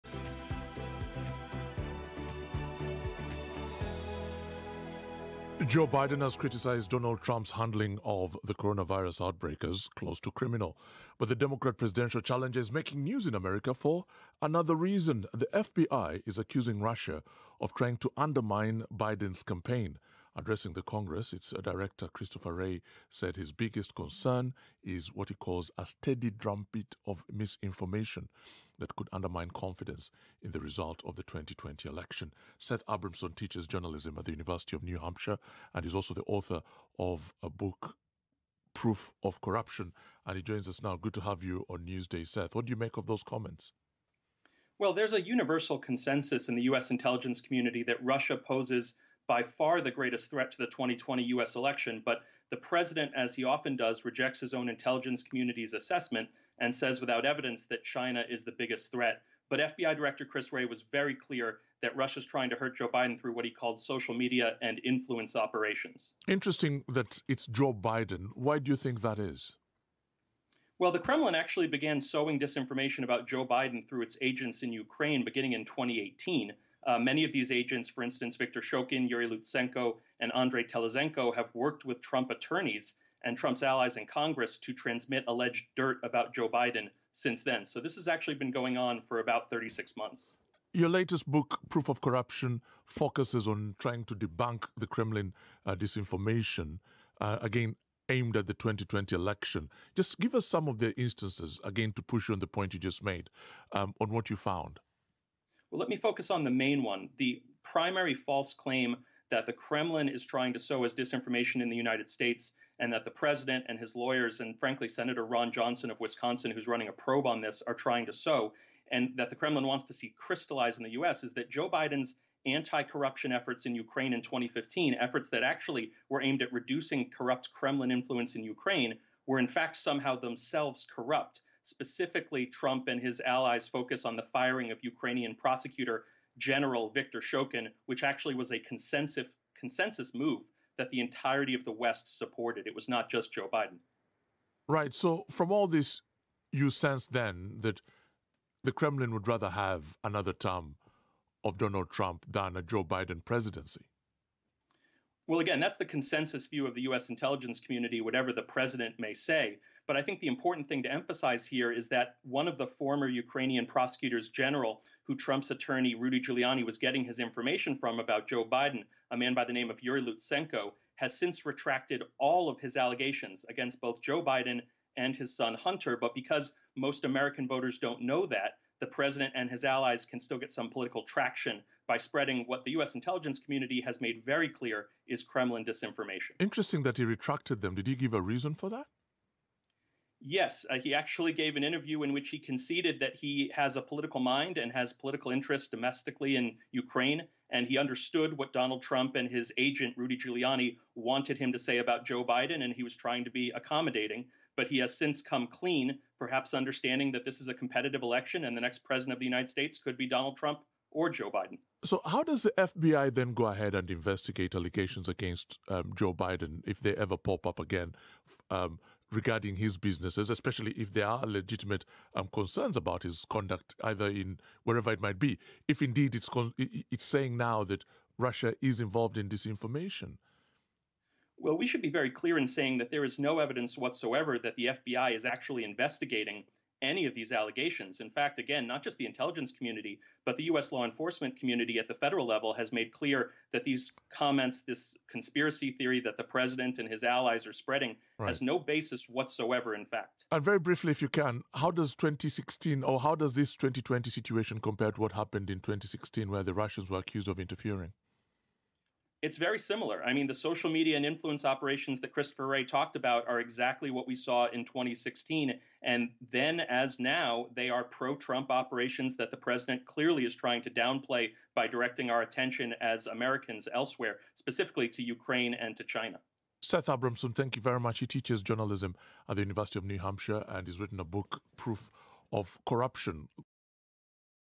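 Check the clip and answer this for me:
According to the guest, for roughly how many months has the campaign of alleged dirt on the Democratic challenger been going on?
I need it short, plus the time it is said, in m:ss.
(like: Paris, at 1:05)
36, at 1:29.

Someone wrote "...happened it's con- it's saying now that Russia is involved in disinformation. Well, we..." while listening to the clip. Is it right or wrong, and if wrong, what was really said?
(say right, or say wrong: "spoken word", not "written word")
wrong: "indeed", not "happened".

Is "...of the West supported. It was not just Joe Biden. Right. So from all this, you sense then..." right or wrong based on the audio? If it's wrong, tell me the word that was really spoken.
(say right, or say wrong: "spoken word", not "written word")
right.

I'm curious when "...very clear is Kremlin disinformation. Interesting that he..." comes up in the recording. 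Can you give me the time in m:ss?
3:04.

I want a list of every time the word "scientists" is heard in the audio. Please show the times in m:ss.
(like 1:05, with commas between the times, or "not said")
not said.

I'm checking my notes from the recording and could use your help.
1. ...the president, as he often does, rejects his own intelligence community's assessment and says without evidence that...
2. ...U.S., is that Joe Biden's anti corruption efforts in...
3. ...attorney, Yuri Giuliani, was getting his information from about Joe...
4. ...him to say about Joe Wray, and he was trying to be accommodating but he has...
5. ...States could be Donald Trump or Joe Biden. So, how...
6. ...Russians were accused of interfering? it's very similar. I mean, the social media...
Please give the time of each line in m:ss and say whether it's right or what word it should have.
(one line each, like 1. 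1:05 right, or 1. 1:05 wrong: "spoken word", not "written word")
1. 0:52 right
2. 2:00 right
3. 2:45 wrong: "Rudy", not "Yuri"
4. 3:21 wrong: "Biden", not "Wray"
5. 3:29 right
6. 4:16 right.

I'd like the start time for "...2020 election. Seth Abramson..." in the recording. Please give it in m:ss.
0:31.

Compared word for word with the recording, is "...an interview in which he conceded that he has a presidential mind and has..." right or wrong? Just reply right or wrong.
wrong.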